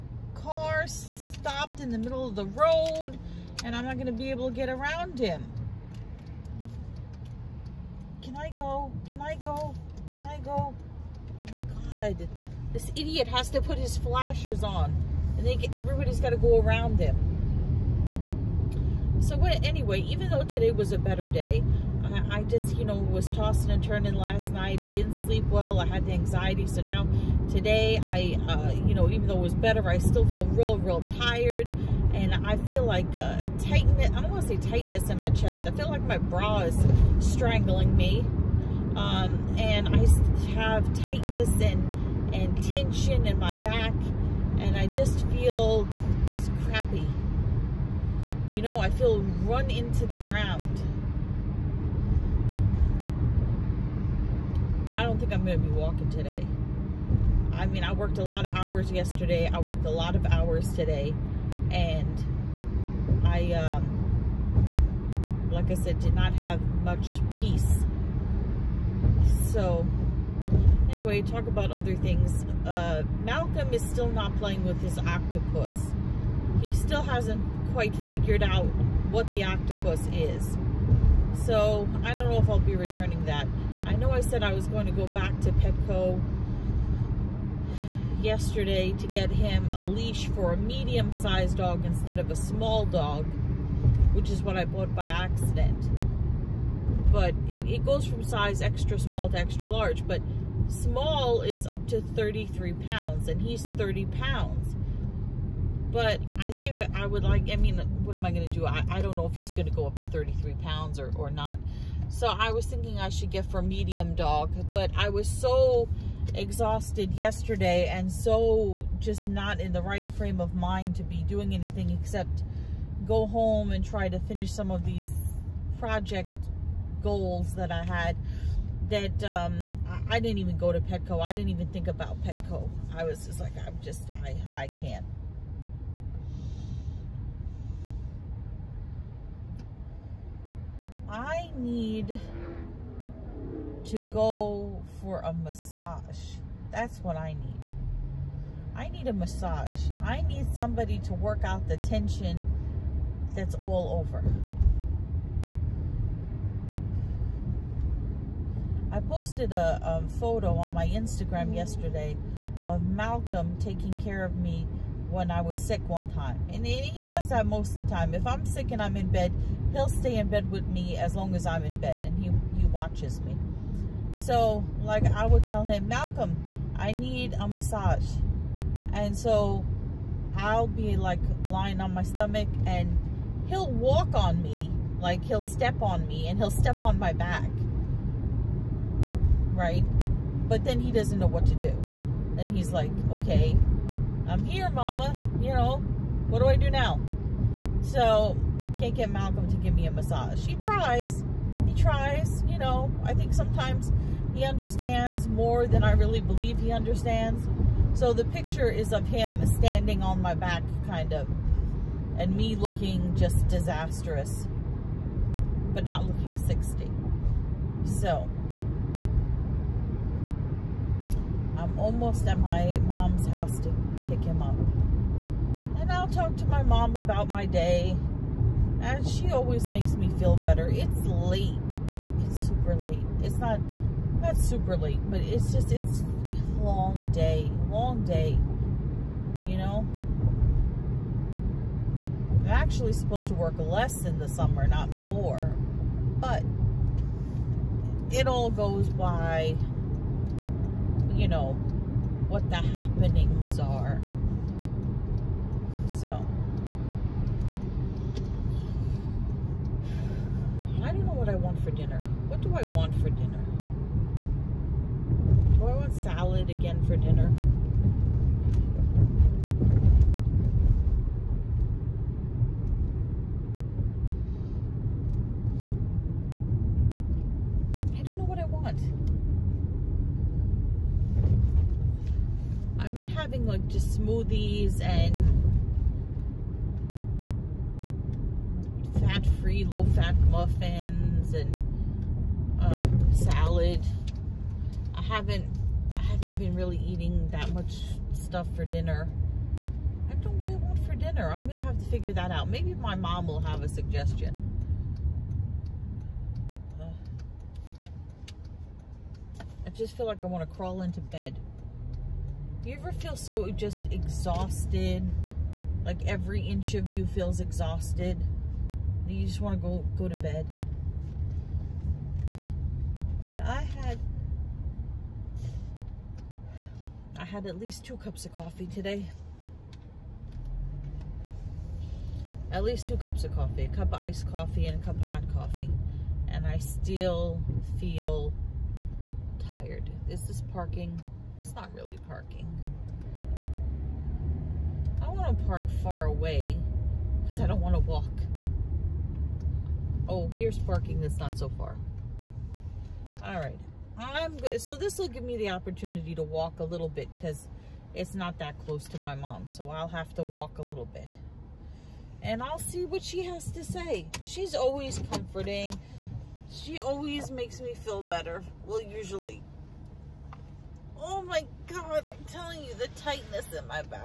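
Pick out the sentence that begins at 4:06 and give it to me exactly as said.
But it all goes by, you know, what the happenings are.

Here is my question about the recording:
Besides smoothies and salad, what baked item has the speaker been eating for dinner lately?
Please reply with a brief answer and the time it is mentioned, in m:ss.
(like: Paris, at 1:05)
low fat muffins, at 4:49.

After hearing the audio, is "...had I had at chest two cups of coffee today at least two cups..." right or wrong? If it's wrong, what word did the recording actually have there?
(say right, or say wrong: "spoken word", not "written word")
wrong: "least", not "chest".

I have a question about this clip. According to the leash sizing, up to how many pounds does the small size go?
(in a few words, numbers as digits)
33 pounds.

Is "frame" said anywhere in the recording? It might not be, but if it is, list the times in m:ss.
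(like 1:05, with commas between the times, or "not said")
2:00.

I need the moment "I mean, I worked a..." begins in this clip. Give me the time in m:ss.
0:57.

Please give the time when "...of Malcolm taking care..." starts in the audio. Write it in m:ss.
2:42.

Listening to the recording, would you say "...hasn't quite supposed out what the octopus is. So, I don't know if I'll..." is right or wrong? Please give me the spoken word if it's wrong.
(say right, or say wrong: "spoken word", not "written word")
wrong: "figured", not "supposed".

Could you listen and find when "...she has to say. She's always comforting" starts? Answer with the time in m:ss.
6:03.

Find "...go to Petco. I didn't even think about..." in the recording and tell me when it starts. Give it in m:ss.
2:10.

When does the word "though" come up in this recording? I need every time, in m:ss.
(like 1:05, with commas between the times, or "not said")
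0:20, 0:29.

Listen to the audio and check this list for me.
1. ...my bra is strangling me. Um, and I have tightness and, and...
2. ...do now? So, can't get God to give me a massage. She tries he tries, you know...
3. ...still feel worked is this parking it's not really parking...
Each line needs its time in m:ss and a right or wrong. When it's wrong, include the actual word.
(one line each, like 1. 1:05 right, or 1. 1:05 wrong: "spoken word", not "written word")
1. 0:36 right
2. 3:16 wrong: "Malcolm", not "God"
3. 5:36 wrong: "tired", not "worked".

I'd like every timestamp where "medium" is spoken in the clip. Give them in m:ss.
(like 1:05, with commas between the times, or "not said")
1:30, 1:53.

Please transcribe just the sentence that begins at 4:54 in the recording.
I haven't I haven't been really eating that much stuff for dinner.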